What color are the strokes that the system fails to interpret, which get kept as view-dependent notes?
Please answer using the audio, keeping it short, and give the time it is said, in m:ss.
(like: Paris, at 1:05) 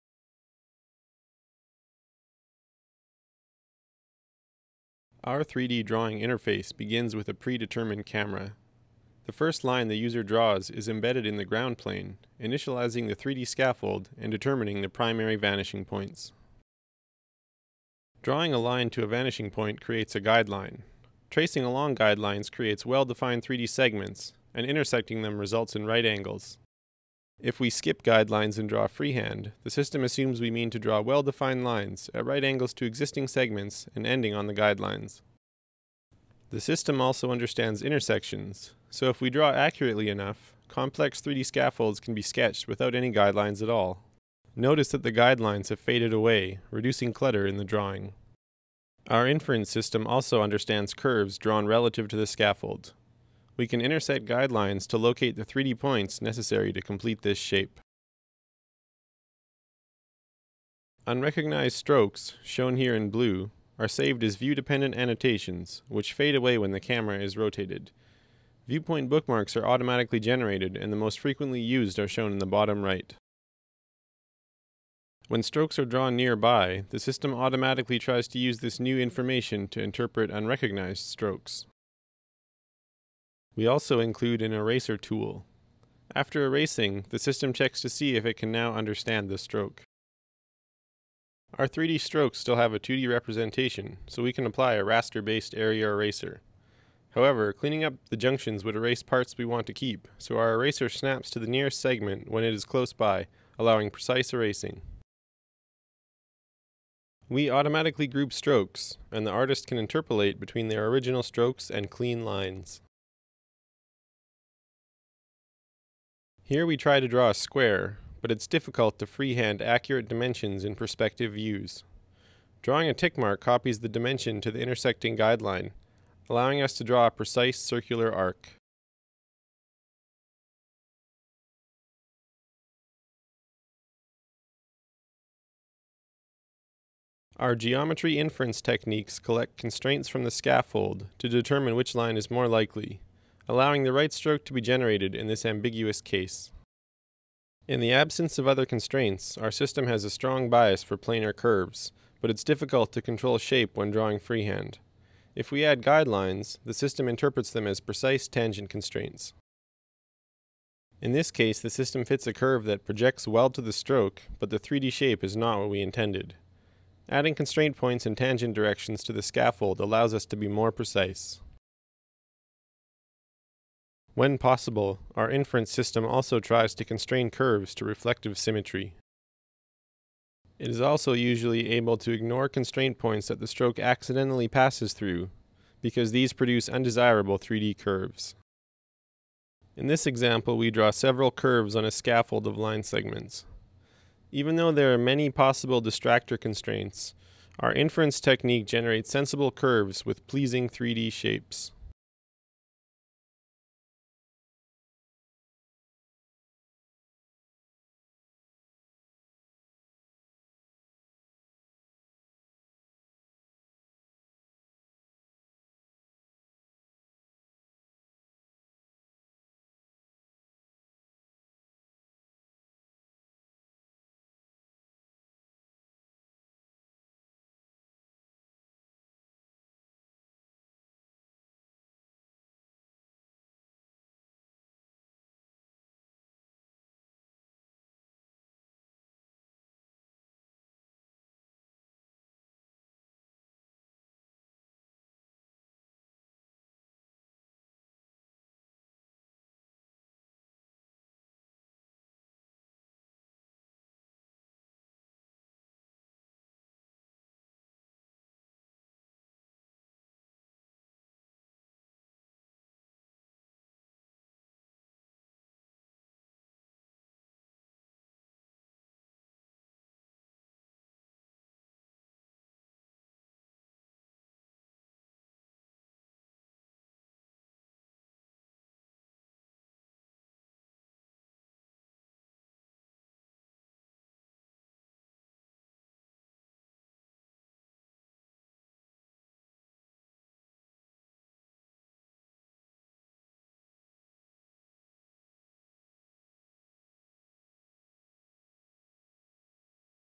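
blue, at 1:03.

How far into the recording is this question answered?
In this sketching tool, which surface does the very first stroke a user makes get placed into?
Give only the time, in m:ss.
0:11.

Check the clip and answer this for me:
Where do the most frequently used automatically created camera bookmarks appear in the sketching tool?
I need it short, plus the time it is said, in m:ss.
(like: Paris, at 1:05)
bottom right, at 1:12.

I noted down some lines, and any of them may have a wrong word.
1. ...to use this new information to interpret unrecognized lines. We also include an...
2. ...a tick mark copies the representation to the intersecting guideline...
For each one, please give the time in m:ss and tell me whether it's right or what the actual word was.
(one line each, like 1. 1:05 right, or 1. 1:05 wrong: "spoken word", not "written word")
1. 1:18 wrong: "strokes", not "lines"
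2. 2:02 wrong: "dimension", not "representation".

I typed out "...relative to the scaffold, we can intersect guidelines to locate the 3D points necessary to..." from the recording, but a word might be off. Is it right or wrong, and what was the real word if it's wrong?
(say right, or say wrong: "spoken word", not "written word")
right.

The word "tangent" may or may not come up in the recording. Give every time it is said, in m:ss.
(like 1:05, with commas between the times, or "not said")
2:38, 2:48.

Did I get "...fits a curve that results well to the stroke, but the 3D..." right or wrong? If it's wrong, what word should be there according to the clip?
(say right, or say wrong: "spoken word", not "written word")
wrong: "projects", not "results".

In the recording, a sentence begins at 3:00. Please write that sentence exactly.
It is also usually able to ignore constraint points that the stroke accidentally passes through, because these produce undesirable 3D curves.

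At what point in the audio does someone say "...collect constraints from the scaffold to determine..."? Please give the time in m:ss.
2:19.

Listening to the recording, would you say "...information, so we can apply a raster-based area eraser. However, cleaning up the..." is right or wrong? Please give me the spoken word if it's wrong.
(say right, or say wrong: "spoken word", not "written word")
wrong: "representation", not "information".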